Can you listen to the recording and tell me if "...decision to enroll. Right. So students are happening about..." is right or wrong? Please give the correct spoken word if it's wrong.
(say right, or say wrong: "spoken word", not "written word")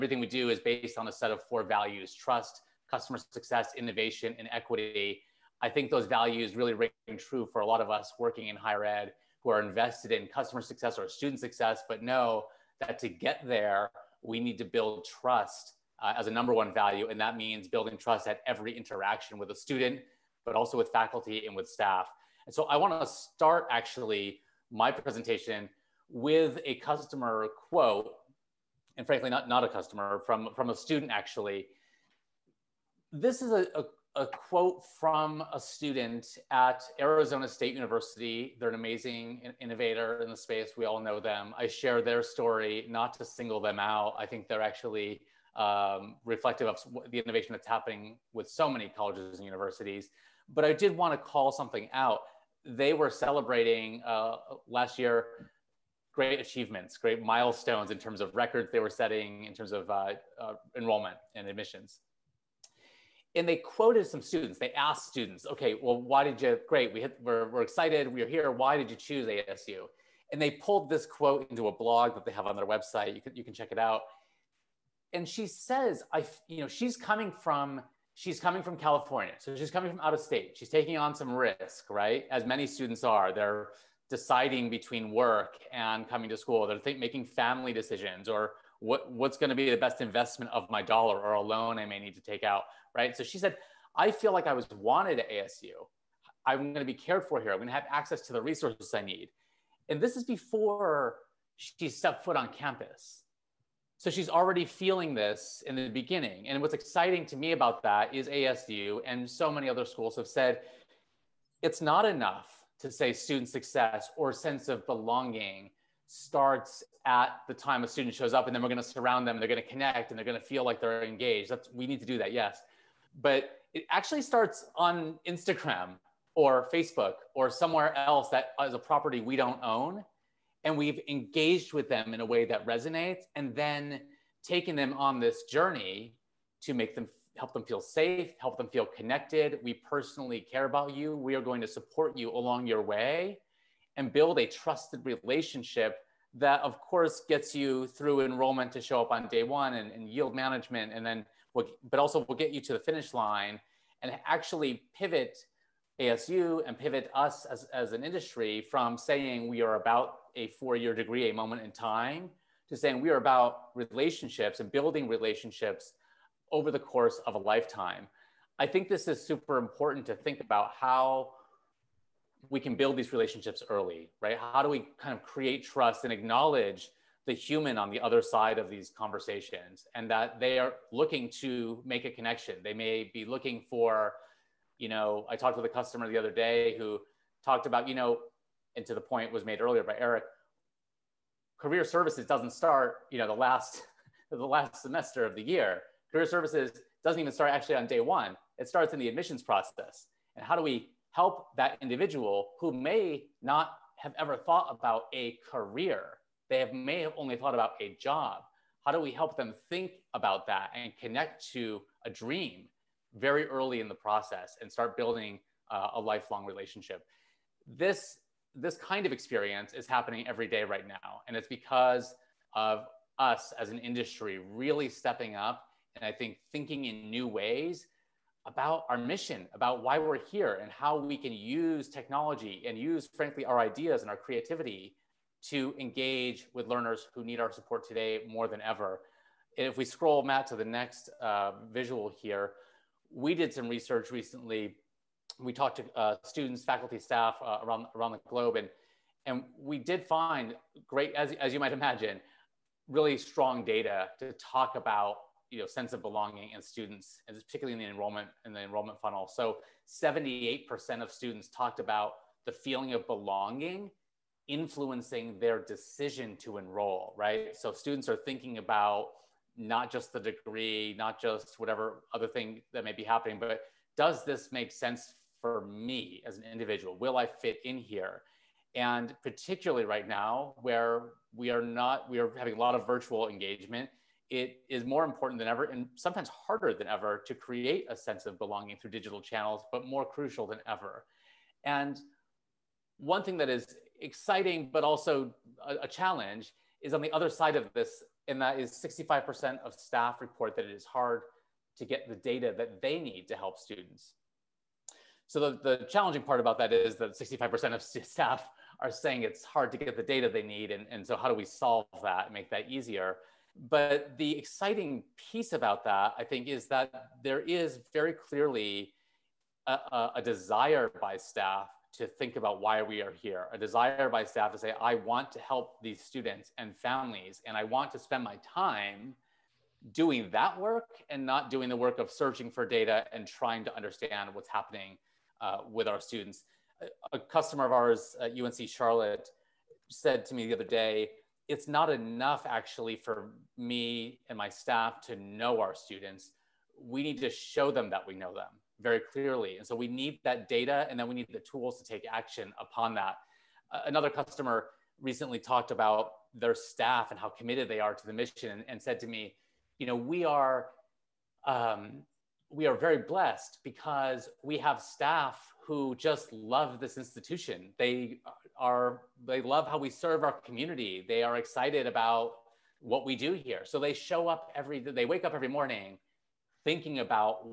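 wrong: "thinking", not "happening".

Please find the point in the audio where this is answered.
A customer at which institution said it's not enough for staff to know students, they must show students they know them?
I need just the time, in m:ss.
5:38.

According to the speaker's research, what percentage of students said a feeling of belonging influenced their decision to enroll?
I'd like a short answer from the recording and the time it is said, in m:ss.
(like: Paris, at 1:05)
78%, at 4:19.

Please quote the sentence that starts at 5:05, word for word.
So the, the challenging part about that is that 65% of staff are saying it's hard to get the data they need.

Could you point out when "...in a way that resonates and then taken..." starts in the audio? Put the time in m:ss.
2:12.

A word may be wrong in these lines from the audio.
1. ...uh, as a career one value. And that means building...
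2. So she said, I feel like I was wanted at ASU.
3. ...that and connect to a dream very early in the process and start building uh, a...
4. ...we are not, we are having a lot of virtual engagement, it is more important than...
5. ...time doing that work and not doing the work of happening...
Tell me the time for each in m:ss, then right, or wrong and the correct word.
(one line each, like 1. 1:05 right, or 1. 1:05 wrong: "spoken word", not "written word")
1. 0:16 wrong: "number", not "career"
2. 1:33 right
3. 3:30 right
4. 4:41 right
5. 5:28 wrong: "searching", not "happening".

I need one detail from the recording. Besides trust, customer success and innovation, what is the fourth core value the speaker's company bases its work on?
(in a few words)
Equity.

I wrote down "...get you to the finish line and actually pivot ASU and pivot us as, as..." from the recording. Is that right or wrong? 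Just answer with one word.
right.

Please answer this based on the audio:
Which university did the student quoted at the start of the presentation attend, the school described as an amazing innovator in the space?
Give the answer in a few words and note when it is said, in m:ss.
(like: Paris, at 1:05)
Arizona State University, at 0:37.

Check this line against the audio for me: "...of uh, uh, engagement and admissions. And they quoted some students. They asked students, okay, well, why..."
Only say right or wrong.
wrong.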